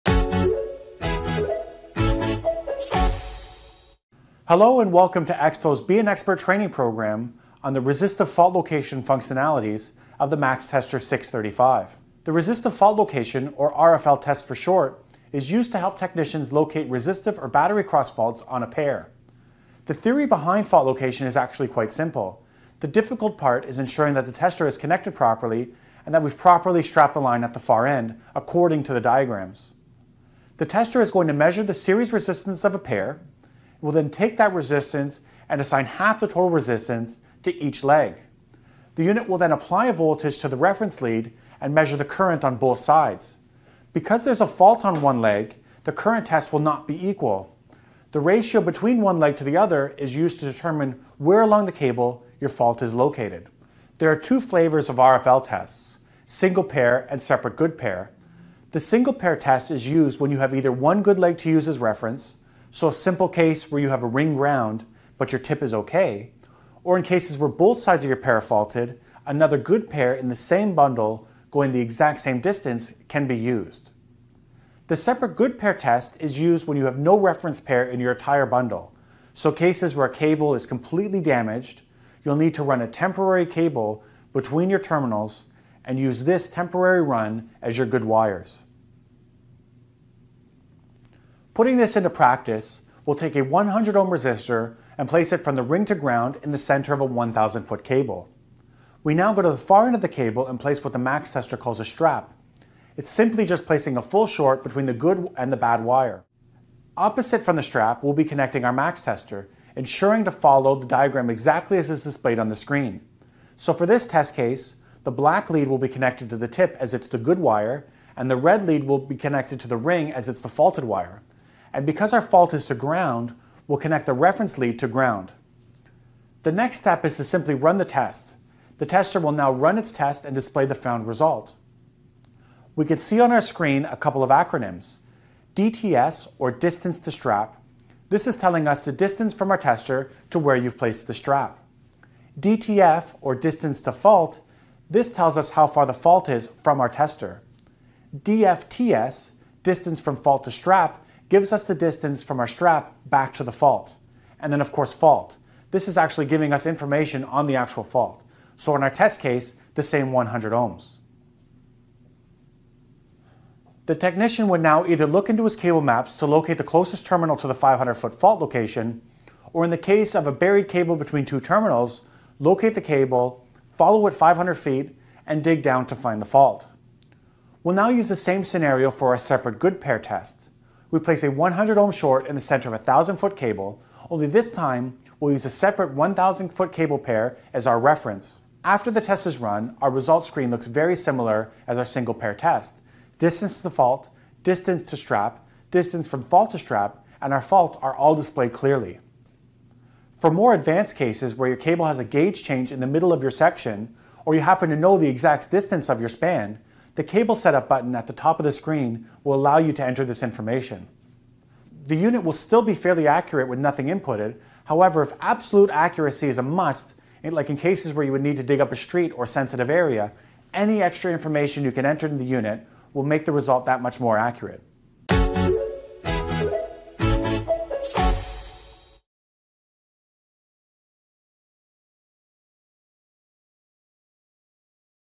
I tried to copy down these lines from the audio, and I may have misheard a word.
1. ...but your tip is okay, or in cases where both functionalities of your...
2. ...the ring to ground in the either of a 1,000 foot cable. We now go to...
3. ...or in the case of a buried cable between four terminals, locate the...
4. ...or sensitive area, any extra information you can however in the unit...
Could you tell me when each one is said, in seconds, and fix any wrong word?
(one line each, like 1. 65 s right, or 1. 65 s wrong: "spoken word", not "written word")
1. 65 s wrong: "sides", not "functionalities"
2. 95 s wrong: "center", not "either"
3. 169 s wrong: "two", not "four"
4. 219 s wrong: "enter", not "however".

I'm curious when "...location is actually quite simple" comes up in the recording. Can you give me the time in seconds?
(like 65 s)
20 s.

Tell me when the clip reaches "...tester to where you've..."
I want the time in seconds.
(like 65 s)
139 s.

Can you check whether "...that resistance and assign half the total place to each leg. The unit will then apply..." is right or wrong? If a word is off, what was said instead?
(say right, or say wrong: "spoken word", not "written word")
wrong: "resistance", not "place".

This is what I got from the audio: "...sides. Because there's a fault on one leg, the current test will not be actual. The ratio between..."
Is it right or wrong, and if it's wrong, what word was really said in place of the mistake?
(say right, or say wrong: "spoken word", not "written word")
wrong: "equal", not "actual".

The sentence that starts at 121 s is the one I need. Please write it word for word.
And because our fault is to ground, we'll connect the reference lead to ground.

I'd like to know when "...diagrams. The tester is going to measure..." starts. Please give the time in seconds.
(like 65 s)
28 s.